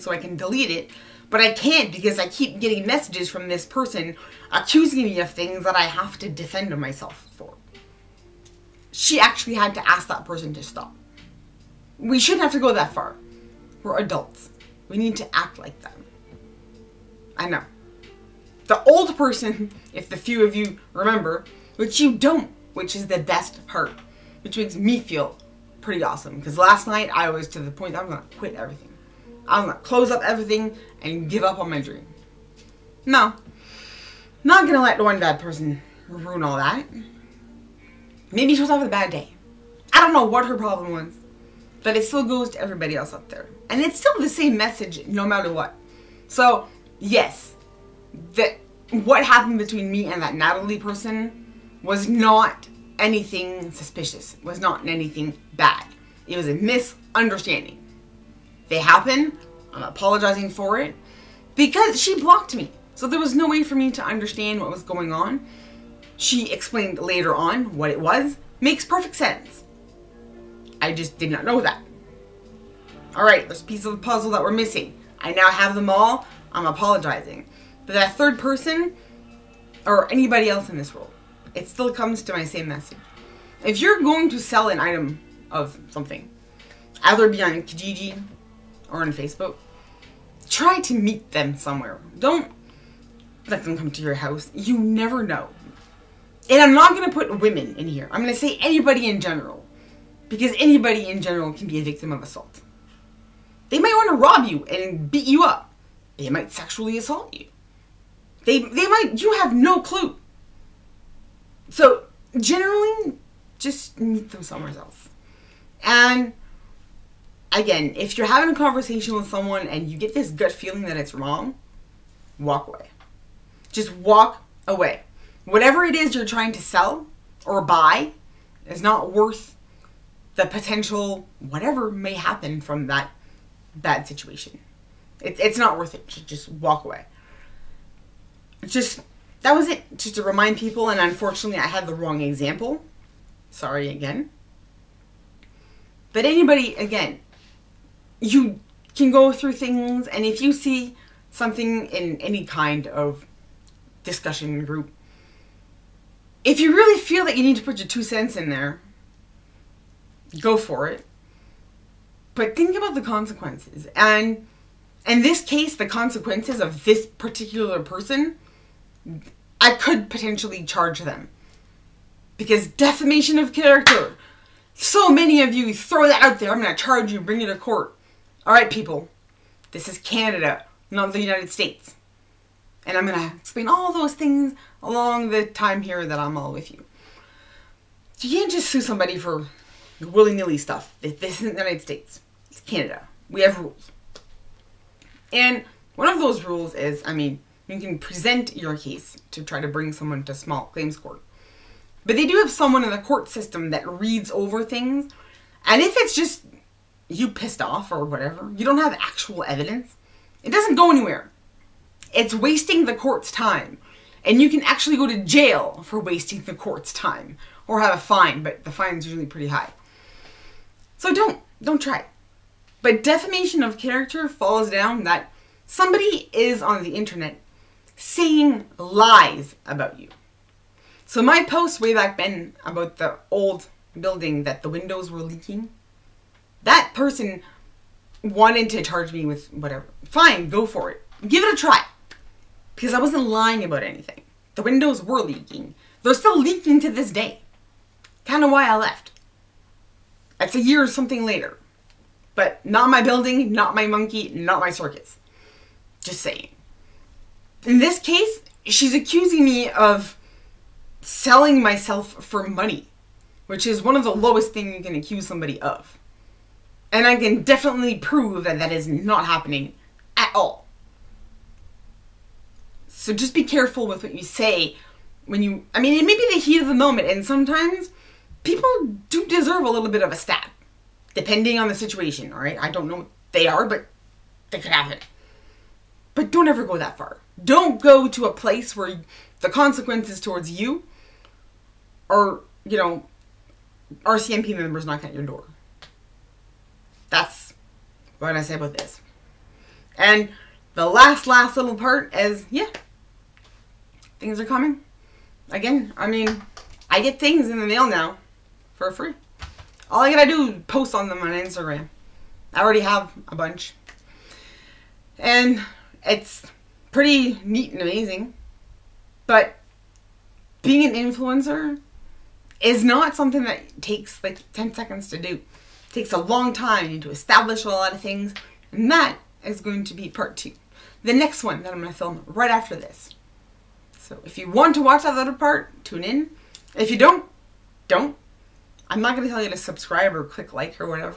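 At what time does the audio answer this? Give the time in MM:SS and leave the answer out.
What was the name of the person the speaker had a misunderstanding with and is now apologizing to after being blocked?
00:50.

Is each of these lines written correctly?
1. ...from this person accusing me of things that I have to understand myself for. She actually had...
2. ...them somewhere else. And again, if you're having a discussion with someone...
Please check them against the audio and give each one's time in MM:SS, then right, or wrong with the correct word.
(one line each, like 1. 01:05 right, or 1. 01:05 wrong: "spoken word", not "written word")
1. 00:03 wrong: "defend", not "understand"
2. 01:54 wrong: "conversation", not "discussion".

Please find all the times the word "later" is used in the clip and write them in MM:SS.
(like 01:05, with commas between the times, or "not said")
01:06, 04:11.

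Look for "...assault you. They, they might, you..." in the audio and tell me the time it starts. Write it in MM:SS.
01:46.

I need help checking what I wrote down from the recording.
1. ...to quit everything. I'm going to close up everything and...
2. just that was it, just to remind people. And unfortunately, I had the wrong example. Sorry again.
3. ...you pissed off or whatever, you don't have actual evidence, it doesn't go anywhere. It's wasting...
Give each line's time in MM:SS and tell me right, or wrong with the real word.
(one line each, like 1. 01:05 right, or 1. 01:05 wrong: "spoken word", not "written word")
1. 00:28 right
2. 02:18 right
3. 03:27 right.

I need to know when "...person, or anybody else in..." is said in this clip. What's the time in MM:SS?
01:18.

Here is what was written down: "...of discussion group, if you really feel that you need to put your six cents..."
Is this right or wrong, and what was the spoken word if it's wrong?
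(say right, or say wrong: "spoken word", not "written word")
wrong: "two", not "six".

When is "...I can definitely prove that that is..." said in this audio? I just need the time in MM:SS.
04:27.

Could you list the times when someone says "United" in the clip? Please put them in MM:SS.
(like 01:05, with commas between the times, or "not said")
03:01, 03:11.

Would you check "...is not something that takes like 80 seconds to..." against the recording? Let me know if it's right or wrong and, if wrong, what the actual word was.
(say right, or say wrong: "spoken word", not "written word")
wrong: "10", not "80".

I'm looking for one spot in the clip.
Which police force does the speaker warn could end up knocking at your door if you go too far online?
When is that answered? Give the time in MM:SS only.
04:54.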